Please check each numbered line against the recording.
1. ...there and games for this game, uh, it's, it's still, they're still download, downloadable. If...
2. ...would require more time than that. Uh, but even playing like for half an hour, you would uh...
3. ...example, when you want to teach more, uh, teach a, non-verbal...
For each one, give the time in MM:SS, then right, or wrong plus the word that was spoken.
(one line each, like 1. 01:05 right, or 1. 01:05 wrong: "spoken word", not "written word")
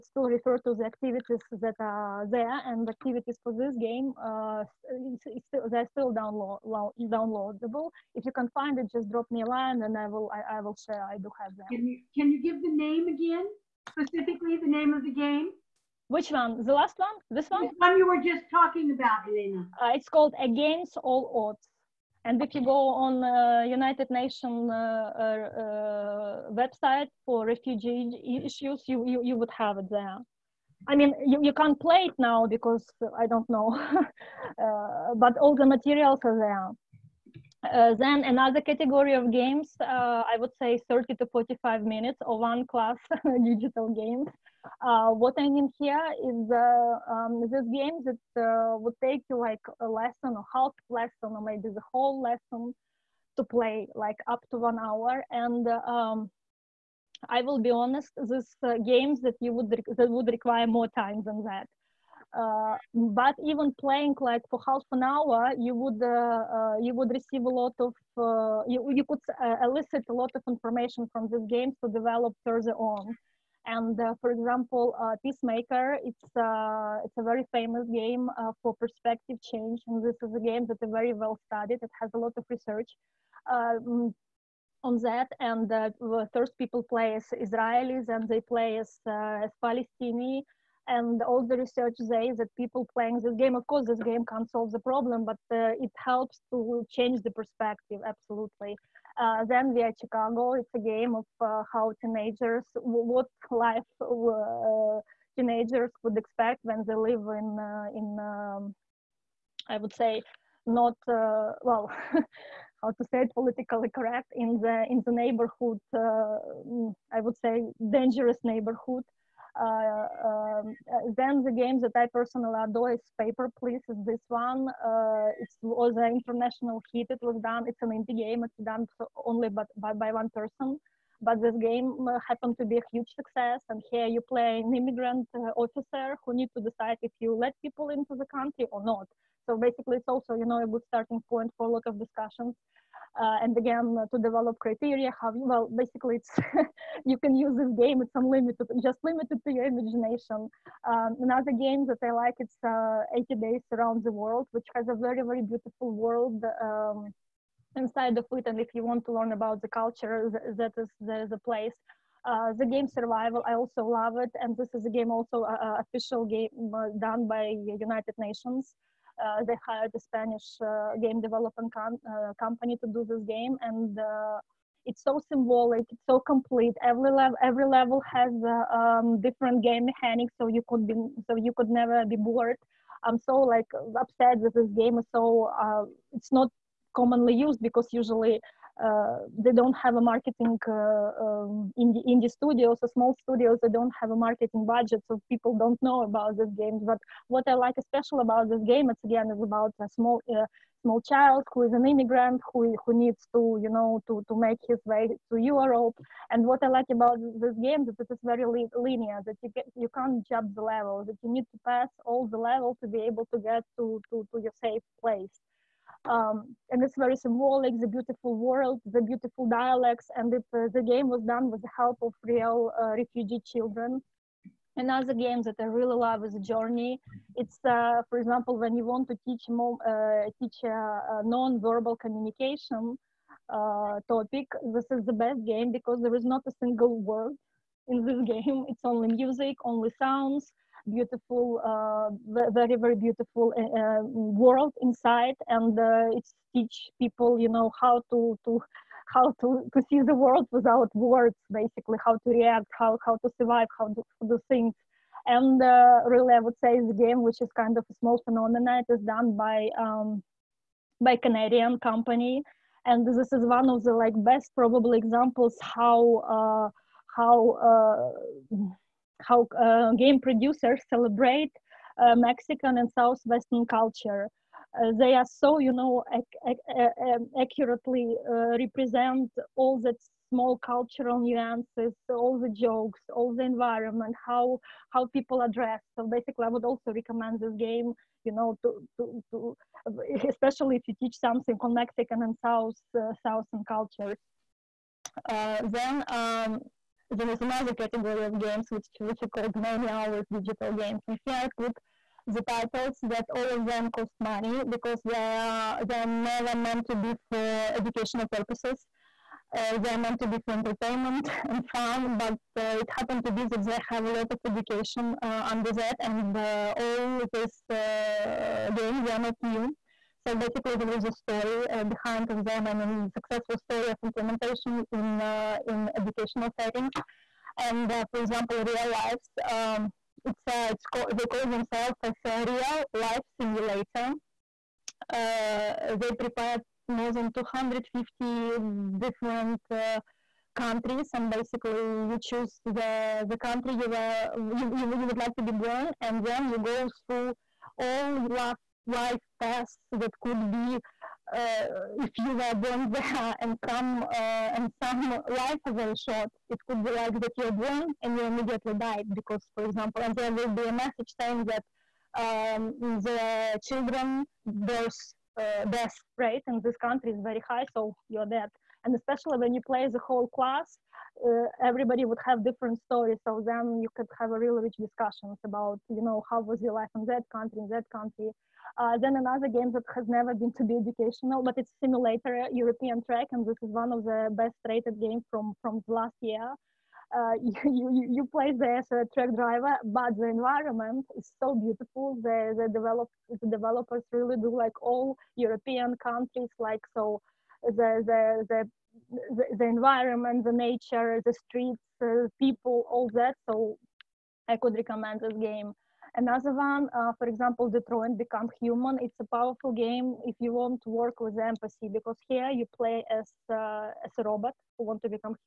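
1. 00:02 wrong: "activities", not "games"
2. 01:00 right
3. 03:48 right.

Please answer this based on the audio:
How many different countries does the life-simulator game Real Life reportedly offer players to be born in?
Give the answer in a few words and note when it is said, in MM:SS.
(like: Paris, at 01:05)
more than 250, at 05:36.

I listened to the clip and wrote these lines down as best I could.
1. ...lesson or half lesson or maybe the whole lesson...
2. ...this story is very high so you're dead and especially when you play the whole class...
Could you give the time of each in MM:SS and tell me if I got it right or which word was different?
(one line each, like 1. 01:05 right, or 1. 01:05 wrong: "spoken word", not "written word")
1. 00:49 right
2. 06:06 wrong: "country", not "story".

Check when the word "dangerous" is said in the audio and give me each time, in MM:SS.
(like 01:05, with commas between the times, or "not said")
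01:57.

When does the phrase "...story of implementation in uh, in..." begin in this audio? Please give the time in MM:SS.
05:23.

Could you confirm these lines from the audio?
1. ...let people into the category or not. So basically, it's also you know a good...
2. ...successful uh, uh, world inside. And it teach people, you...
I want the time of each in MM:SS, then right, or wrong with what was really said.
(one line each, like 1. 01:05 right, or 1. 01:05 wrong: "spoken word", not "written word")
1. 02:17 wrong: "country", not "category"
2. 04:02 wrong: "beautiful", not "successful".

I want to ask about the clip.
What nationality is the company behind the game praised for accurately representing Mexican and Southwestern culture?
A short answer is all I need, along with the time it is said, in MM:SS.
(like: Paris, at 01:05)
Canadian, at 04:21.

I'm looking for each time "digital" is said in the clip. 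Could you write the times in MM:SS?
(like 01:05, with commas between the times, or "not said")
00:43, 05:00.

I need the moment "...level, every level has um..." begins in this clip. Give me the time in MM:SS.
02:57.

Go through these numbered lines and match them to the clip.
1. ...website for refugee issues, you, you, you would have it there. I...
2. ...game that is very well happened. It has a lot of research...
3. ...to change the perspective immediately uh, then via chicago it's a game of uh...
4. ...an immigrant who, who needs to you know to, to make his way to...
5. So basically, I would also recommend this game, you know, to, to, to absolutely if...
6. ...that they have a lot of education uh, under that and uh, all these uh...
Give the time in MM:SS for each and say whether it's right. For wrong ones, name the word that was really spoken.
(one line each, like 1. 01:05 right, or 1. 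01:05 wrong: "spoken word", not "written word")
1. 00:26 right
2. 01:20 wrong: "studied", not "happened"
3. 01:36 wrong: "absolutely", not "immediately"
4. 03:21 right
5. 04:45 wrong: "especially", not "absolutely"
6. 05:13 right.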